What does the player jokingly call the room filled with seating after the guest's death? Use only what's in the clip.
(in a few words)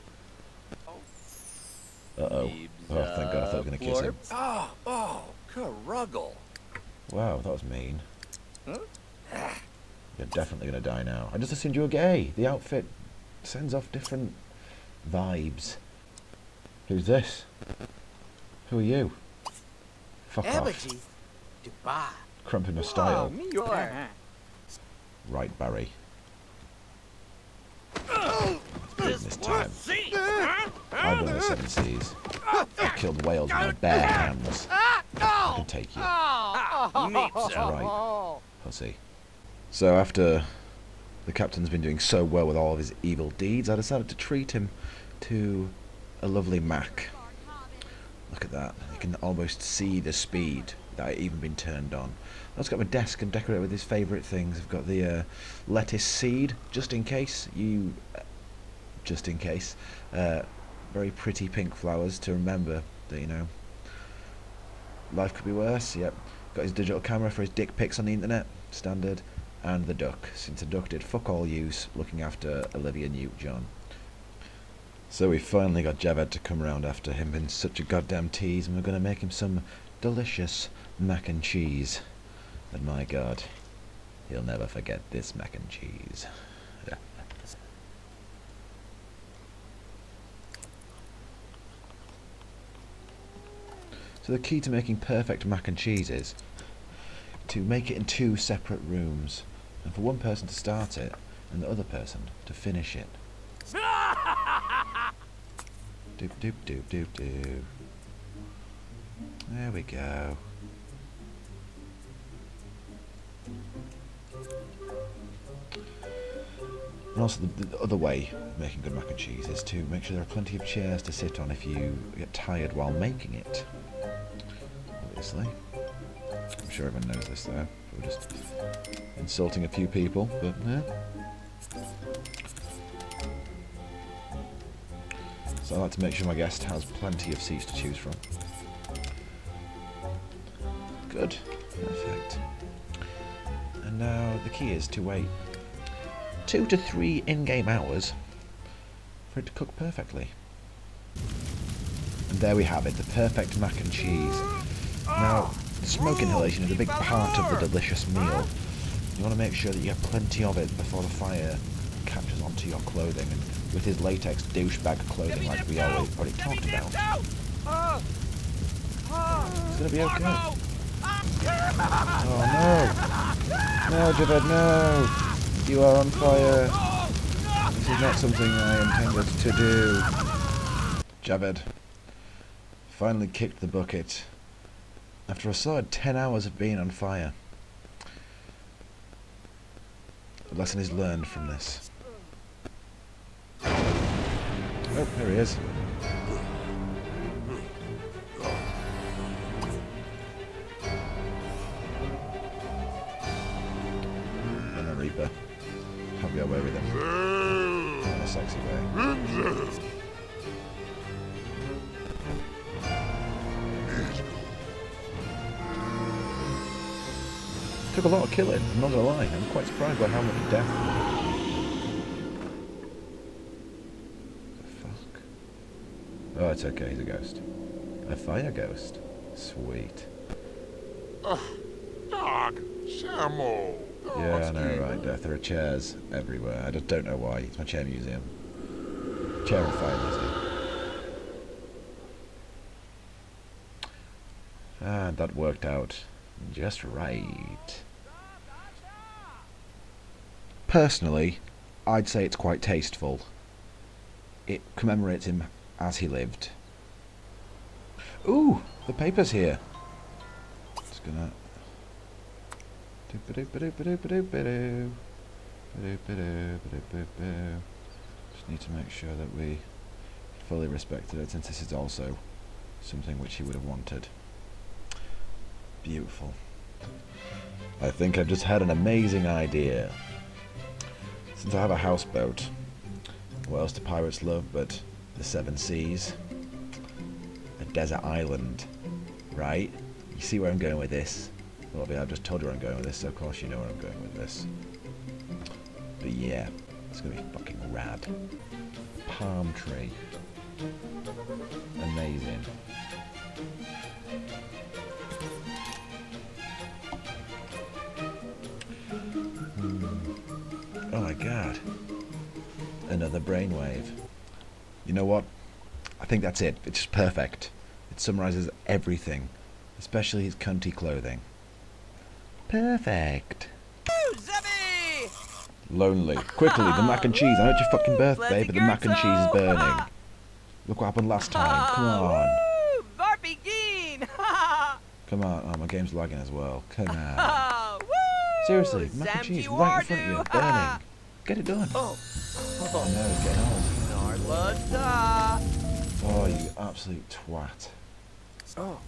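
Chair museum.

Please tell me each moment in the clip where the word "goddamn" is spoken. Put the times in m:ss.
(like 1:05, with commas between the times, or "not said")
1:17.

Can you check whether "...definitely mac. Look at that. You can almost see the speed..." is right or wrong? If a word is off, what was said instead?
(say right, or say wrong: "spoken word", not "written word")
wrong: "lovely", not "definitely".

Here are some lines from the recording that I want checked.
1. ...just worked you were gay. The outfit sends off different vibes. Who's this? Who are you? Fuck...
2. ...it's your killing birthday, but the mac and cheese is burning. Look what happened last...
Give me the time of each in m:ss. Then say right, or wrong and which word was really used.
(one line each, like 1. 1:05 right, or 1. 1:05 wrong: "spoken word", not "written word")
1. 0:11 wrong: "assumed", not "worked"
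2. 5:27 wrong: "fucking", not "killing".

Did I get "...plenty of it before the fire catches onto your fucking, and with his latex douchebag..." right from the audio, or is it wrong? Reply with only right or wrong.
wrong.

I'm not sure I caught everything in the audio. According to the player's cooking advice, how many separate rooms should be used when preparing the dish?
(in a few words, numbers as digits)
2.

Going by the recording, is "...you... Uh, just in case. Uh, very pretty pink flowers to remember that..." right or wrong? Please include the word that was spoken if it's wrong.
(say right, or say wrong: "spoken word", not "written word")
right.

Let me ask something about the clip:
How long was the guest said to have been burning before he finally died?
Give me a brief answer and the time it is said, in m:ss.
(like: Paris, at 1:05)
10 hours, at 3:05.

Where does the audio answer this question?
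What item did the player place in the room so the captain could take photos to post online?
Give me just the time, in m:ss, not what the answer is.
1:06.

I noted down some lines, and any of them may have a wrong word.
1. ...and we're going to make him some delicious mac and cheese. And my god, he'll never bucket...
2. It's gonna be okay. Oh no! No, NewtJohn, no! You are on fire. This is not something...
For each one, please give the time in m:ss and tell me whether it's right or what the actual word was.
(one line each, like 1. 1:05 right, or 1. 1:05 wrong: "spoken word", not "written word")
1. 1:18 wrong: "forget", not "bucket"
2. 2:49 wrong: "Javid", not "NewtJohn".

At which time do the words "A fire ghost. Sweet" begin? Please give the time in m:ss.
3:48.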